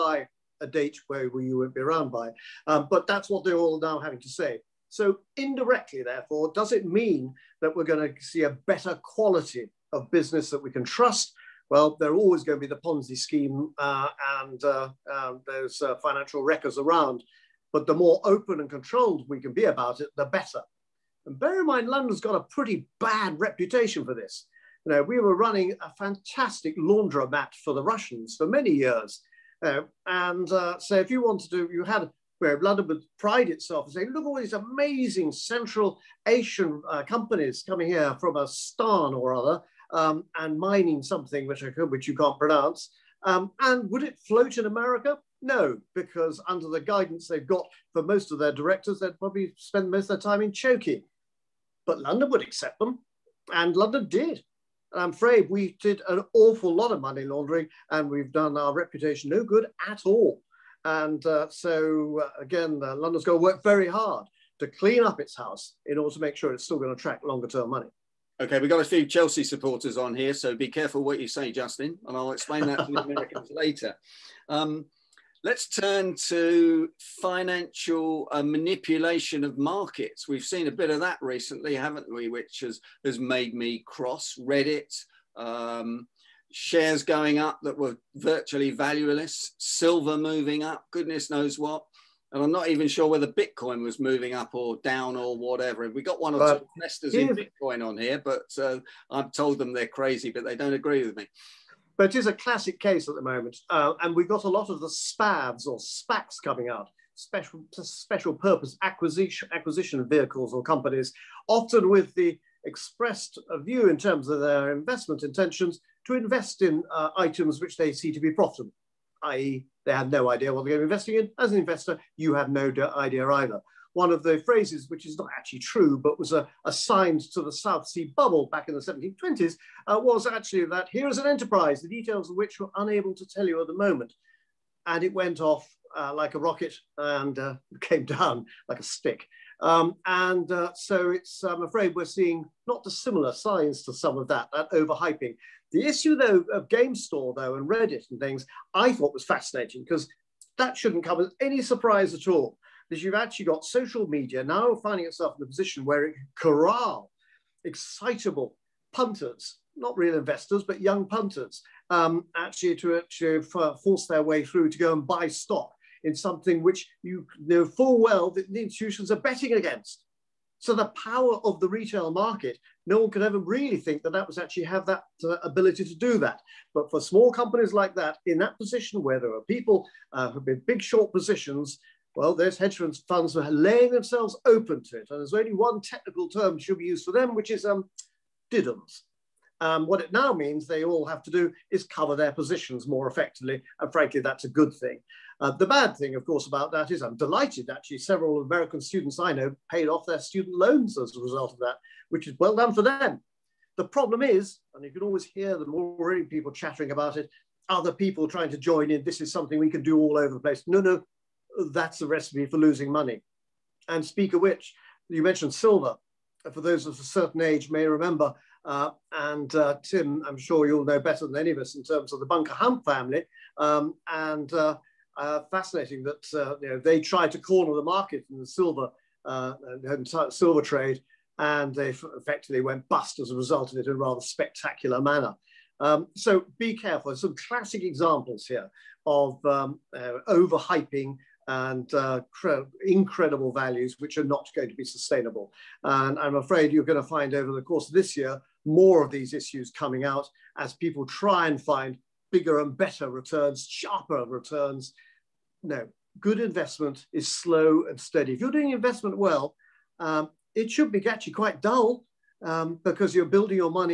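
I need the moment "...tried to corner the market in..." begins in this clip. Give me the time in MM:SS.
03:47.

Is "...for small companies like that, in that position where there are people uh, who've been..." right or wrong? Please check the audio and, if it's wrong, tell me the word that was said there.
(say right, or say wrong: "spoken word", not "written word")
right.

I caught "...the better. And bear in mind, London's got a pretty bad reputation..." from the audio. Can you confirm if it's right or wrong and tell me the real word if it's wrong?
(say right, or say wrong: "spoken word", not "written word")
right.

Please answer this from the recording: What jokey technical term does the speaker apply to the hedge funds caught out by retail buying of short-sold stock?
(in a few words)
diddums.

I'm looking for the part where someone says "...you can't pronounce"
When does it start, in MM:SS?
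00:42.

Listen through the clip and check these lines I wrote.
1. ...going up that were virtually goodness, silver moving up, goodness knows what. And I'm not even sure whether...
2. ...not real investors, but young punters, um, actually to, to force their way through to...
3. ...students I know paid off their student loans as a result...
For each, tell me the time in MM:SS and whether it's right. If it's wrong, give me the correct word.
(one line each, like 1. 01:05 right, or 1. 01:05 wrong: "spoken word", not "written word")
1. 01:27 wrong: "valueless", not "goodness"
2. 02:39 right
3. 03:18 right.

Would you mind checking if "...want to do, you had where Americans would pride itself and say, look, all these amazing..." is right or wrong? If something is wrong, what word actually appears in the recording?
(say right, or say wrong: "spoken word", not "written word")
wrong: "London", not "Americans".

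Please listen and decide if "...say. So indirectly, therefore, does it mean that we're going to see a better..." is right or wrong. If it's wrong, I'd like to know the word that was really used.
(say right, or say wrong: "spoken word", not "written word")
right.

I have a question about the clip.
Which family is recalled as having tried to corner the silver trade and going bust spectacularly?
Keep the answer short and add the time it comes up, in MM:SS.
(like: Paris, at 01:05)
Bunker Hunt family, at 03:42.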